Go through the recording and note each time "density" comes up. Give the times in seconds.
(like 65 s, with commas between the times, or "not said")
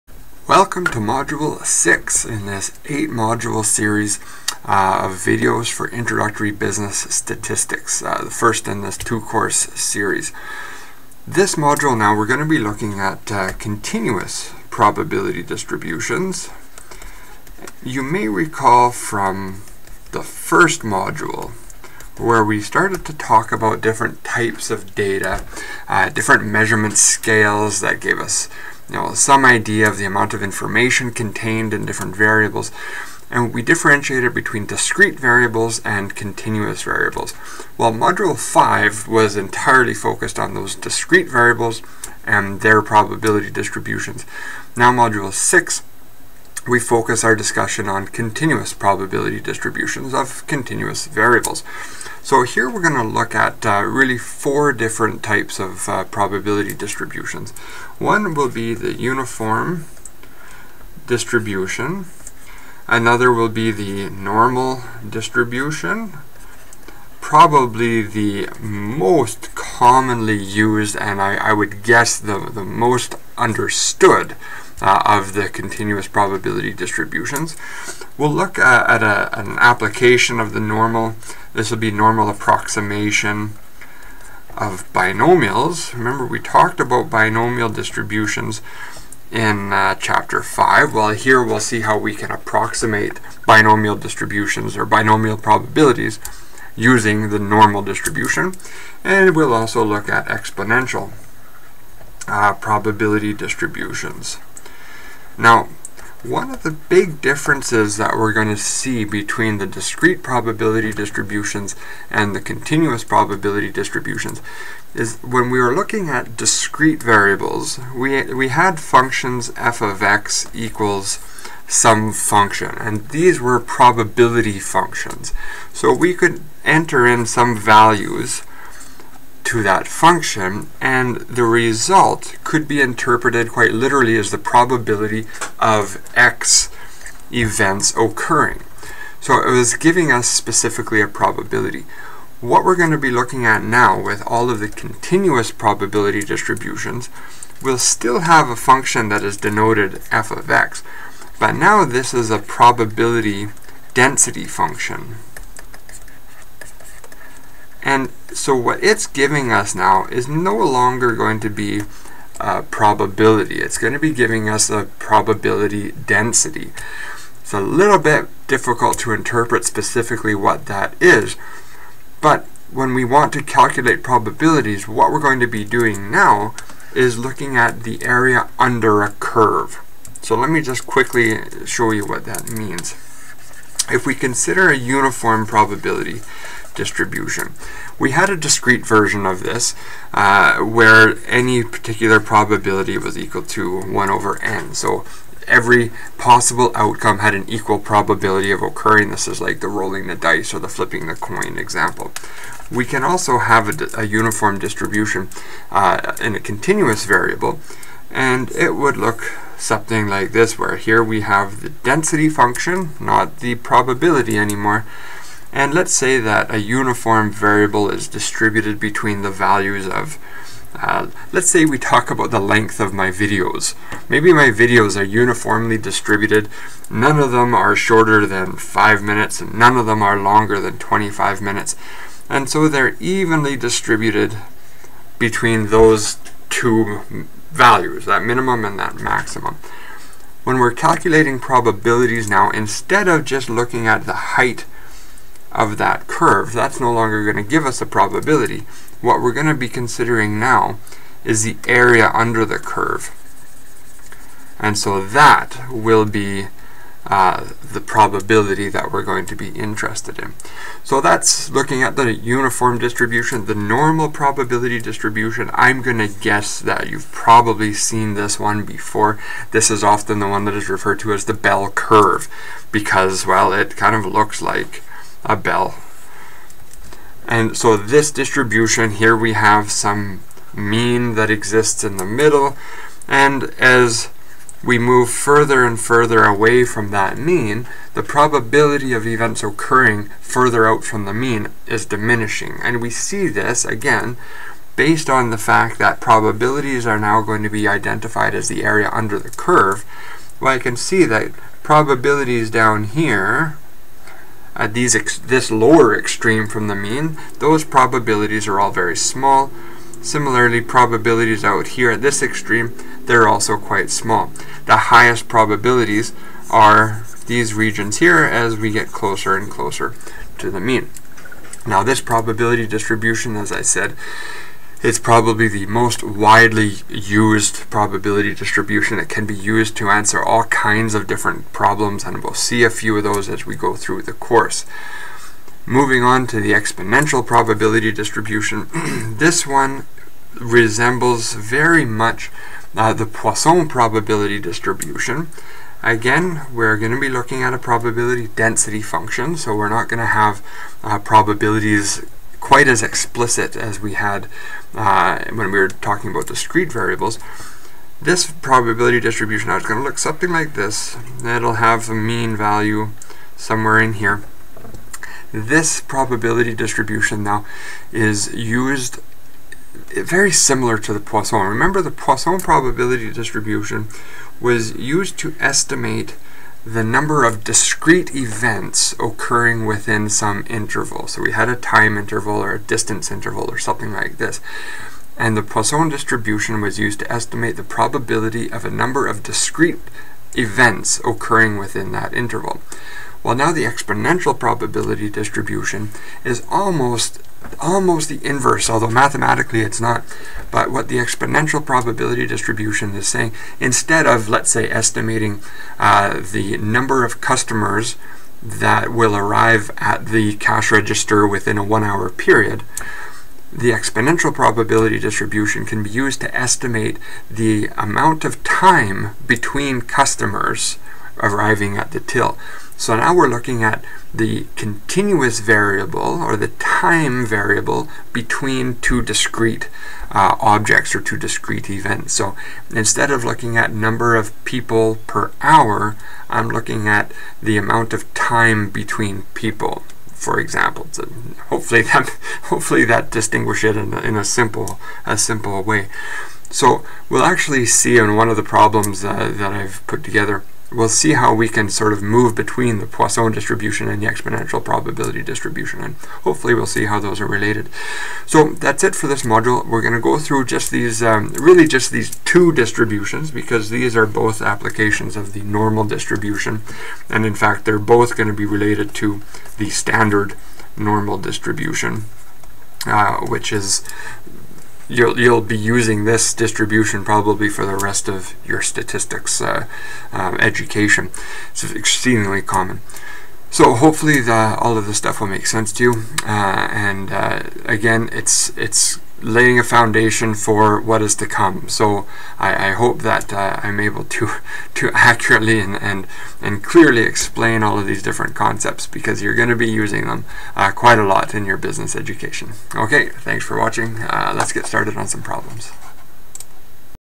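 153 s, 165 s, 211 s, 348 s.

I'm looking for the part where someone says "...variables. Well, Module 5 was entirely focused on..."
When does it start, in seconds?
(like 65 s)
36 s.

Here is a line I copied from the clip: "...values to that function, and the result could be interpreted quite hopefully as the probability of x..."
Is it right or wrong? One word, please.
wrong.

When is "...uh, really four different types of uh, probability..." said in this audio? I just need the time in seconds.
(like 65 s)
53 s.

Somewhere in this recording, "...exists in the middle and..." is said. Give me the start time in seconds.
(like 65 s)
281 s.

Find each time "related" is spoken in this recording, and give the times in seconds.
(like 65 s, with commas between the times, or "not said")
457 s, 468 s.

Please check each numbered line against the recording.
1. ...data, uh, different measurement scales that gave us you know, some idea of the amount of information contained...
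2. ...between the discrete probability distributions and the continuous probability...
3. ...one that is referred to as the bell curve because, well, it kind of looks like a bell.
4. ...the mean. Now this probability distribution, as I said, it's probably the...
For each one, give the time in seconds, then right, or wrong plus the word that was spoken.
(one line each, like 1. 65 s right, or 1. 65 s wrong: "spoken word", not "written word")
1. 24 s right
2. 109 s right
3. 270 s right
4. 320 s right.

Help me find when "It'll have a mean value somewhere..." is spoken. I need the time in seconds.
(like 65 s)
361 s.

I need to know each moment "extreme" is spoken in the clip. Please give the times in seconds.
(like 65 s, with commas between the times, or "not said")
305 s, 312 s.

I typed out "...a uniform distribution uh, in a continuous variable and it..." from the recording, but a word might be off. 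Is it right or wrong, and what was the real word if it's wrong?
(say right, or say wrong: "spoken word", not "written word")
right.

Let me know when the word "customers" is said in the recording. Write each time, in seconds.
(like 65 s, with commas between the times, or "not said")
407 s, 419 s.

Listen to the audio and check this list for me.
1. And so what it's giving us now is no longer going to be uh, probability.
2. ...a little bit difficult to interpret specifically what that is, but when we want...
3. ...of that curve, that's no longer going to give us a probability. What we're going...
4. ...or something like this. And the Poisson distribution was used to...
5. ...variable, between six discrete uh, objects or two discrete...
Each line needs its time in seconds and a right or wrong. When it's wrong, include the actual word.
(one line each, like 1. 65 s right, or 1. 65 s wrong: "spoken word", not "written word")
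1. 157 s right
2. 167 s right
3. 245 s right
4. 383 s right
5. 427 s wrong: "two", not "six".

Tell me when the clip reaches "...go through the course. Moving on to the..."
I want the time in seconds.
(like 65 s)
333 s.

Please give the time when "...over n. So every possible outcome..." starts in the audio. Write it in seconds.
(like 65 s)
194 s.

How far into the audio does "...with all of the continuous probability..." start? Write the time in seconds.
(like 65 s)
144 s.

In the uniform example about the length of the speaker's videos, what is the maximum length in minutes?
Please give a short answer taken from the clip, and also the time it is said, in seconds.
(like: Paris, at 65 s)
25, at 230 s.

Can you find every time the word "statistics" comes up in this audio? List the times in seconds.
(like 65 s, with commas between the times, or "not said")
7 s, 478 s.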